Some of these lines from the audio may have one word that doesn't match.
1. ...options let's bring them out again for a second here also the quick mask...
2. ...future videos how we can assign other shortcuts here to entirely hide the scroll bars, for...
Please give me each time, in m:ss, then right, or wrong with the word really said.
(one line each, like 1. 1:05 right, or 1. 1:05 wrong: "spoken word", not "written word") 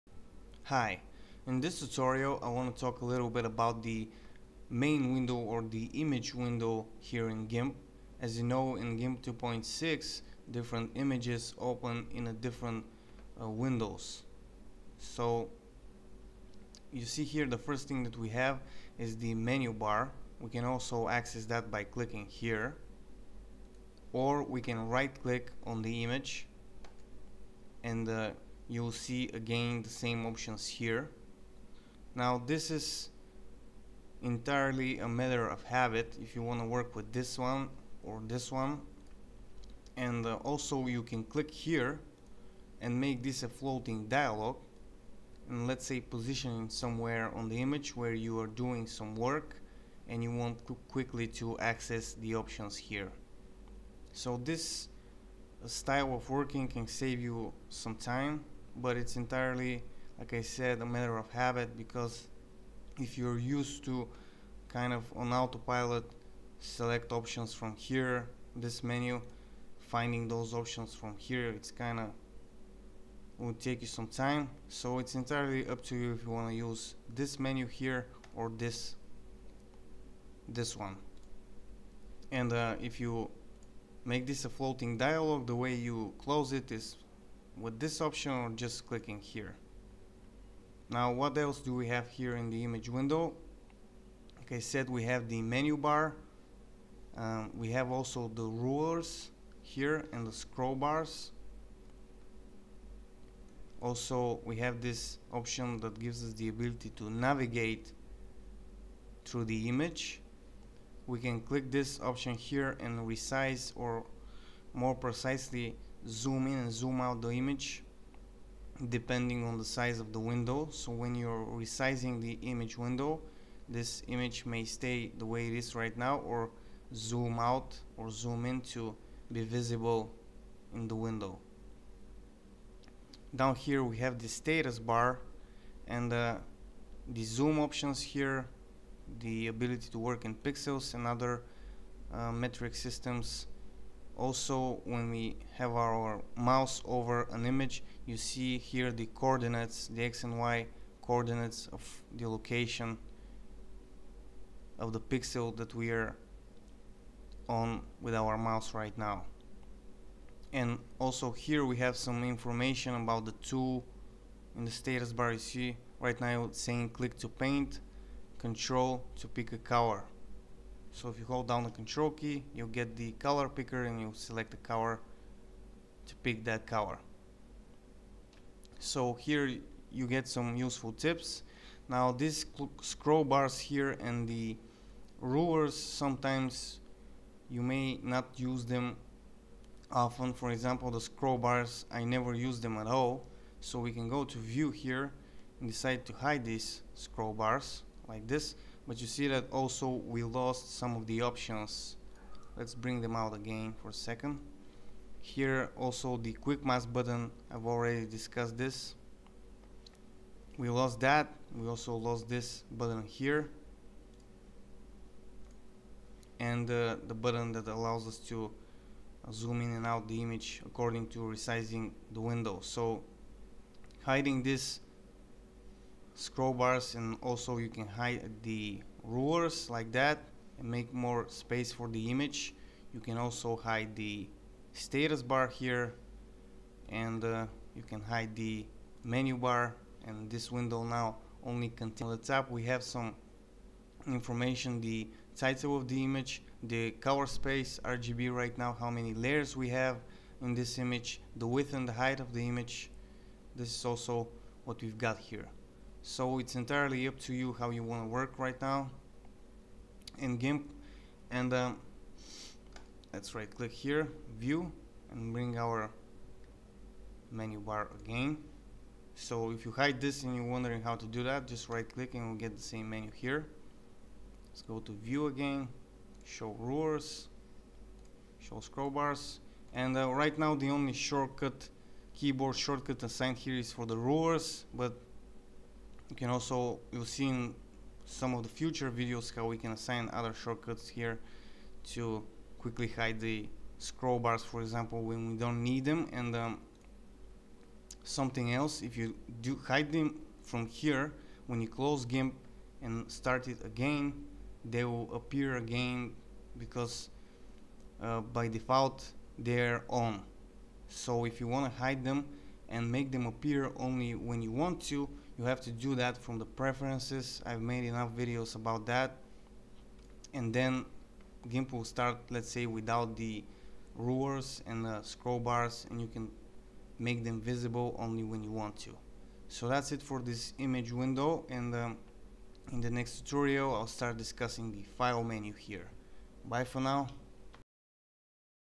1. 3:21 right
2. 4:48 wrong: "quickly", not "entirely".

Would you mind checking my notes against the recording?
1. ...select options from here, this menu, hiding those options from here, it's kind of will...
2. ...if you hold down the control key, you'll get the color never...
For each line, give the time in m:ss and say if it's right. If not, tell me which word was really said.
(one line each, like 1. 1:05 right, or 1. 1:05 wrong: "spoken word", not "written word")
1. 1:06 wrong: "finding", not "hiding"
2. 2:51 wrong: "picker", not "never".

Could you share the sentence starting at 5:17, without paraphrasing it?
I've made enough videos about that.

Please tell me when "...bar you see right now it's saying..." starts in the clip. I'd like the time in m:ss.
2:45.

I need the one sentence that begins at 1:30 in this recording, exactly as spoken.
Now what else do we have here in the image window?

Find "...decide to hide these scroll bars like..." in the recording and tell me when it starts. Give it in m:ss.
3:15.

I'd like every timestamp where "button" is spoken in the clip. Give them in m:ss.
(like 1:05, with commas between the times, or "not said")
3:26, 3:32, 3:37.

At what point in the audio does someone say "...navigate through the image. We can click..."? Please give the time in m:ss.
1:47.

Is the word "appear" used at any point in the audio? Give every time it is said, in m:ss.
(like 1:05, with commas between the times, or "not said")
5:05, 5:13.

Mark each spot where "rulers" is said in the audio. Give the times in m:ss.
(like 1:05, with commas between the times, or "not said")
1:38, 3:05, 3:49, 4:36, 4:43, 5:23.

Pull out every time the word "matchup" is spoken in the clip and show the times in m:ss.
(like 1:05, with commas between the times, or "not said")
not said.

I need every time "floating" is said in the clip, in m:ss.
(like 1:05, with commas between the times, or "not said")
0:43, 1:24.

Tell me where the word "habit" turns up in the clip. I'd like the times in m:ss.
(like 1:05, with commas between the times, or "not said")
0:35, 1:01.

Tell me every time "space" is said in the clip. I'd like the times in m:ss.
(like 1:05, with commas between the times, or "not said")
3:51, 4:07.